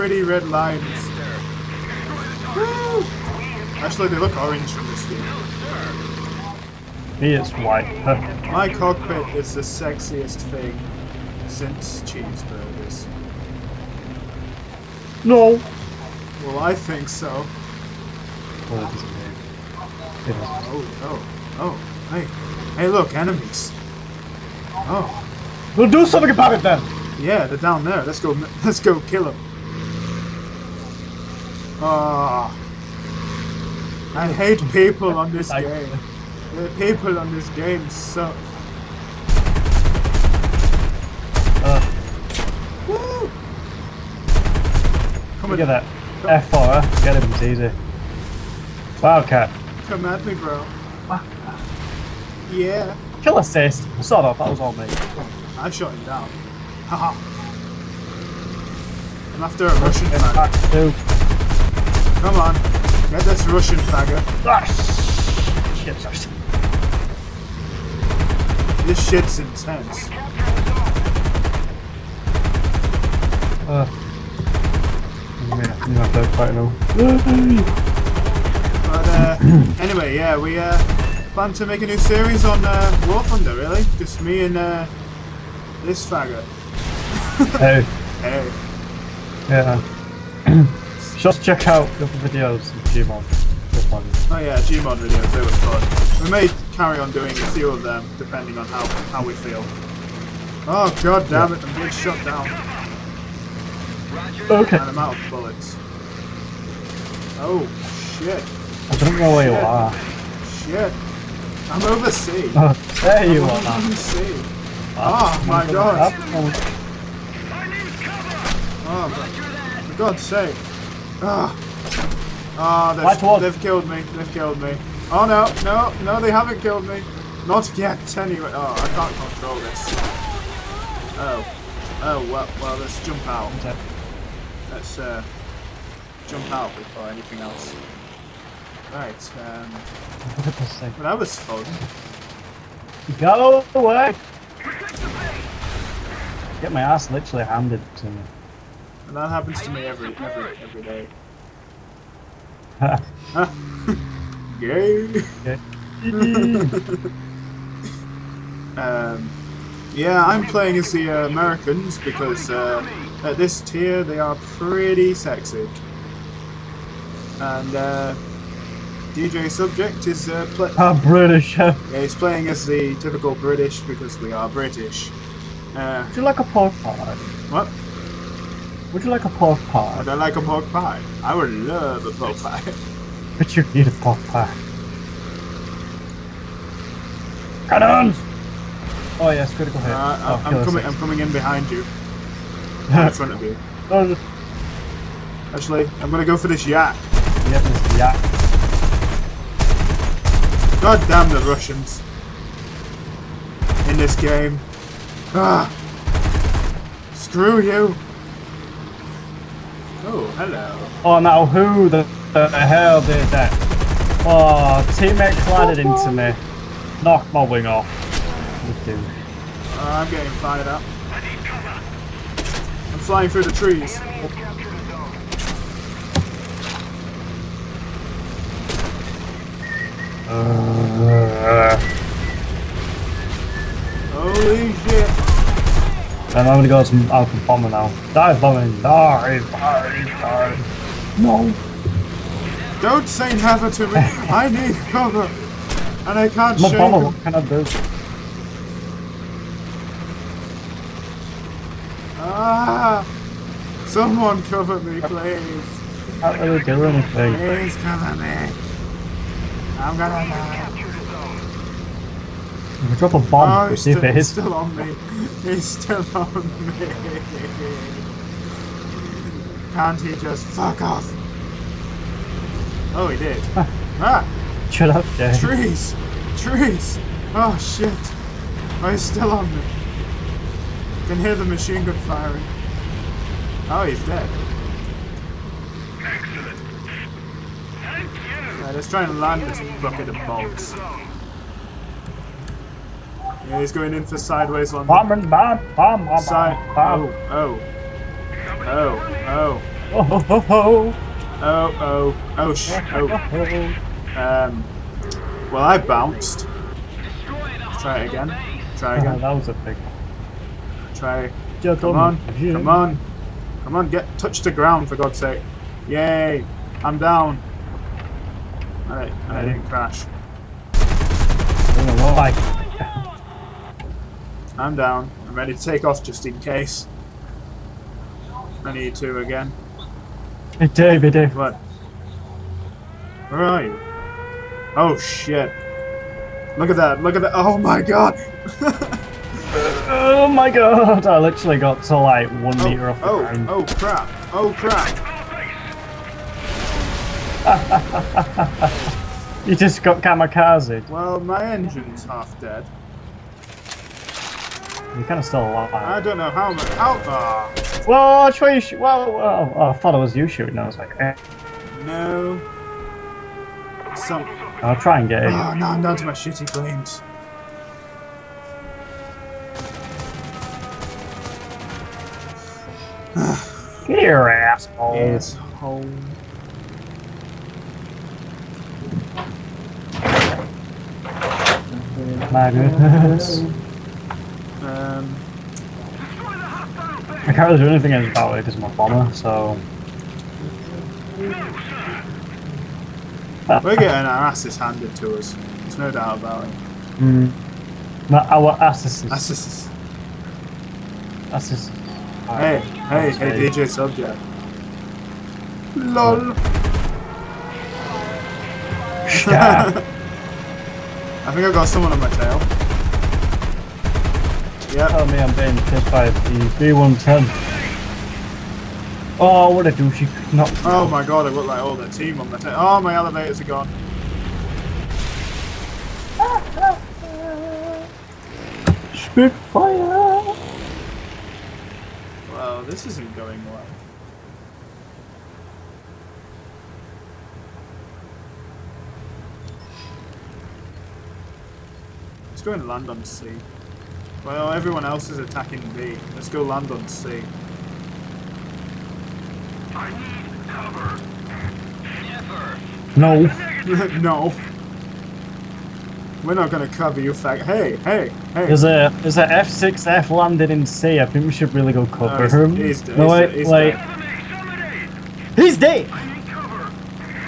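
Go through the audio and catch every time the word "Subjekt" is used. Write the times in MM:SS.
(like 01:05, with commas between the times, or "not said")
02:49, 06:43.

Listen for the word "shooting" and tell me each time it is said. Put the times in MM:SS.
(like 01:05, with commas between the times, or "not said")
06:00.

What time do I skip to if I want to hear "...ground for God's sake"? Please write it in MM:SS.
05:14.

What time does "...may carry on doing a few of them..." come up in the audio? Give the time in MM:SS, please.
01:36.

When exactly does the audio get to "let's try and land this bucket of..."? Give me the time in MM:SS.
04:48.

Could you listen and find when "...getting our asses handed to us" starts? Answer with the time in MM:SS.
06:33.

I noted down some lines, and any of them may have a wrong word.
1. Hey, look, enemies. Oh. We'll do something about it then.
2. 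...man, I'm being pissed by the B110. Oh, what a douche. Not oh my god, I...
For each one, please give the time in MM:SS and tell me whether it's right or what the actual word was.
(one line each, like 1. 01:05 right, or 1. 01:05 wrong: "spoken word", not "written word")
1. 00:22 right
2. 06:55 right.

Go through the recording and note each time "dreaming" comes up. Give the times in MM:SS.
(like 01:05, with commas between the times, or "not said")
not said.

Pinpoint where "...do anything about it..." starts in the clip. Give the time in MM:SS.
06:27.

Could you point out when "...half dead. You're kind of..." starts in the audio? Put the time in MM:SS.
05:52.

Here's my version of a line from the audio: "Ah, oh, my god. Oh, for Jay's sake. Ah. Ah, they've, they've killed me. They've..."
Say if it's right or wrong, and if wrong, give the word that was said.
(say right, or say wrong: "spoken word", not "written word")
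wrong: "God", not "Jay".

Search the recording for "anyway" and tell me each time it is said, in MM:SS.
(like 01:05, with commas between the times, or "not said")
01:19, 02:08.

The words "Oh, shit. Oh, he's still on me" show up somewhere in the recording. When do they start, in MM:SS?
04:37.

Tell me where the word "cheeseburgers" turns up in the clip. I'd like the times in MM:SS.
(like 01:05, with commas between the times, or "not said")
00:12.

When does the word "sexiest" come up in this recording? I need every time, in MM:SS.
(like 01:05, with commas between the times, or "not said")
00:09.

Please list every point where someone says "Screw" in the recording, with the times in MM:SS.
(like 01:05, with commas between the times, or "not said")
03:27.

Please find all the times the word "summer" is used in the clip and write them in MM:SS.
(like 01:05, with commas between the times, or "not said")
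not said.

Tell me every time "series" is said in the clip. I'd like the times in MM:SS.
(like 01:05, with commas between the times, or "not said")
01:21.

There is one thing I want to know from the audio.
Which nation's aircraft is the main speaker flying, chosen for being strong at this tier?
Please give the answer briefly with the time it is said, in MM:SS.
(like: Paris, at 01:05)
Americans, at 02:41.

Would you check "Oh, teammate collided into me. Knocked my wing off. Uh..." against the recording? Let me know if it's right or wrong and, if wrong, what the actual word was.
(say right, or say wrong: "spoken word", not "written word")
right.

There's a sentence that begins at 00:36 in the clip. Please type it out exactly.
The people on this game suck.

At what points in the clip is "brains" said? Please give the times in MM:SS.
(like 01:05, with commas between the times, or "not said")
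06:06.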